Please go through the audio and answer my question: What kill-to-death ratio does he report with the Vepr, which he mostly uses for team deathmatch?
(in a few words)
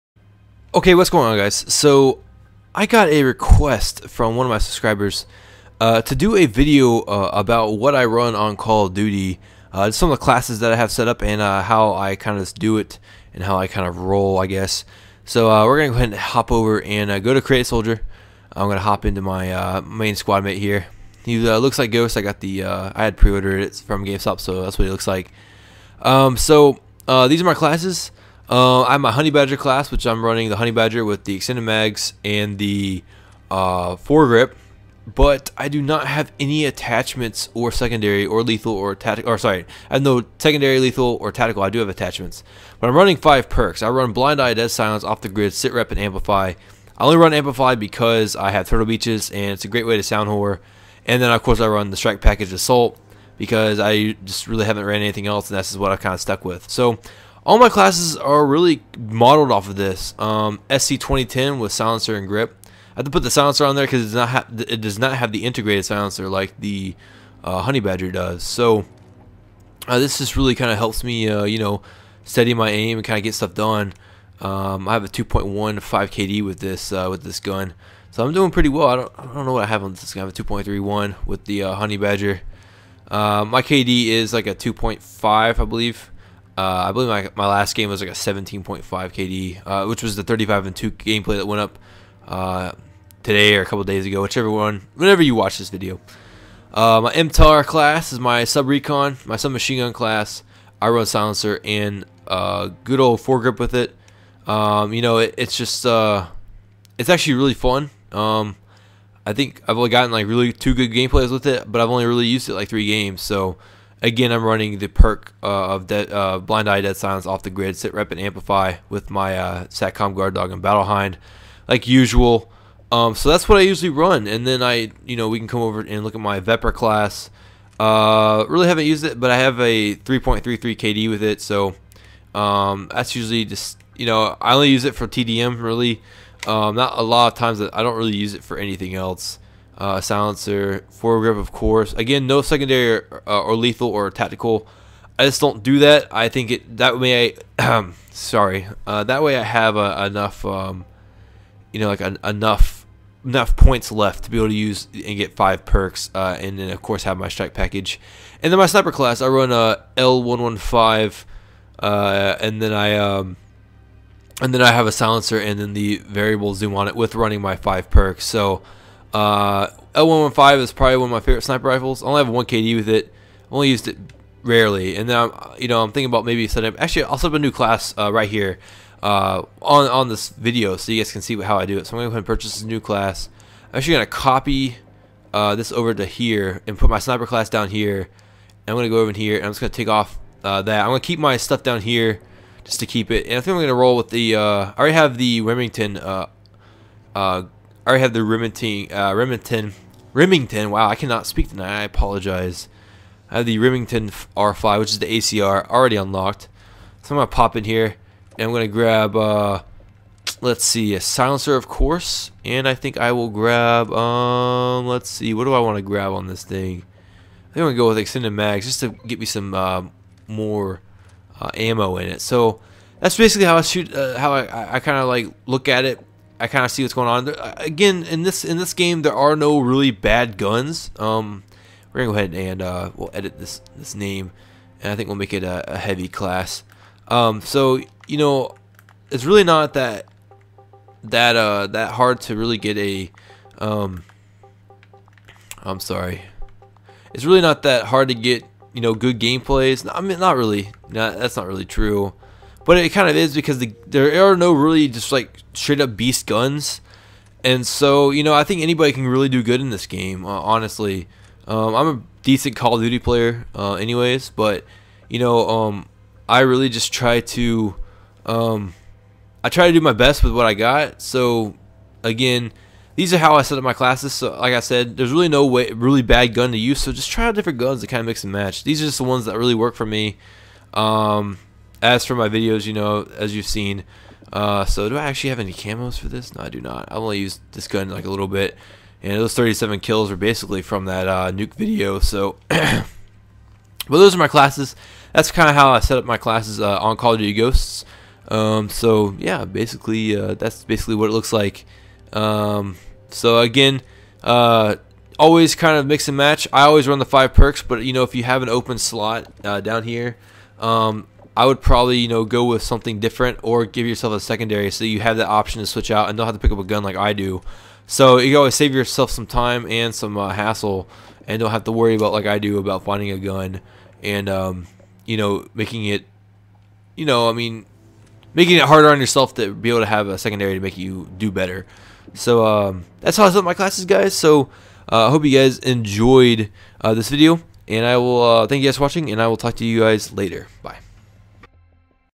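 3.33.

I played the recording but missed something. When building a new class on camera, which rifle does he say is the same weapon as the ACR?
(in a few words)
Remington R5.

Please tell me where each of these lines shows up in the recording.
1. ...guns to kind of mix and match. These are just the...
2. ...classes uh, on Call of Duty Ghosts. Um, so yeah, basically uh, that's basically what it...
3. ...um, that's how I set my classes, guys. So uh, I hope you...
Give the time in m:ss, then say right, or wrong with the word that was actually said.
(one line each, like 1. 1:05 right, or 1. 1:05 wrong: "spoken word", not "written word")
1. 4:37 right
2. 4:56 right
3. 5:32 right.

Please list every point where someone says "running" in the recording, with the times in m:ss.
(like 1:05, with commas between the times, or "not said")
0:30, 0:42, 1:54, 2:47.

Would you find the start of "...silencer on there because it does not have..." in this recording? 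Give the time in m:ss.
1:03.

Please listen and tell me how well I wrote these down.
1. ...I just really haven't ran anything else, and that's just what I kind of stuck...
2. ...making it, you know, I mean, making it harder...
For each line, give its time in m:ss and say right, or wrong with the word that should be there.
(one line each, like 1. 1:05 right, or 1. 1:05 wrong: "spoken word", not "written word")
1. 0:53 right
2. 5:25 right.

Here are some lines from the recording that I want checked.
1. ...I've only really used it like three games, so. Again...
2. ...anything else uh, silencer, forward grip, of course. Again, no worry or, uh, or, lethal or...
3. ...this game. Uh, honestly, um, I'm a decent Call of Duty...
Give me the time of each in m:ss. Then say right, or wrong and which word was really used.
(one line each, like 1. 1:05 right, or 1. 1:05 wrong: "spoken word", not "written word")
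1. 1:51 right
2. 2:18 wrong: "secondary", not "worry"
3. 4:19 right.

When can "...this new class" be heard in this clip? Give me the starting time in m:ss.
3:02.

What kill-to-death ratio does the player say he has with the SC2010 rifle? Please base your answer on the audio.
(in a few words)
2.15.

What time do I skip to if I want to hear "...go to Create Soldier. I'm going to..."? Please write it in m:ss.
0:17.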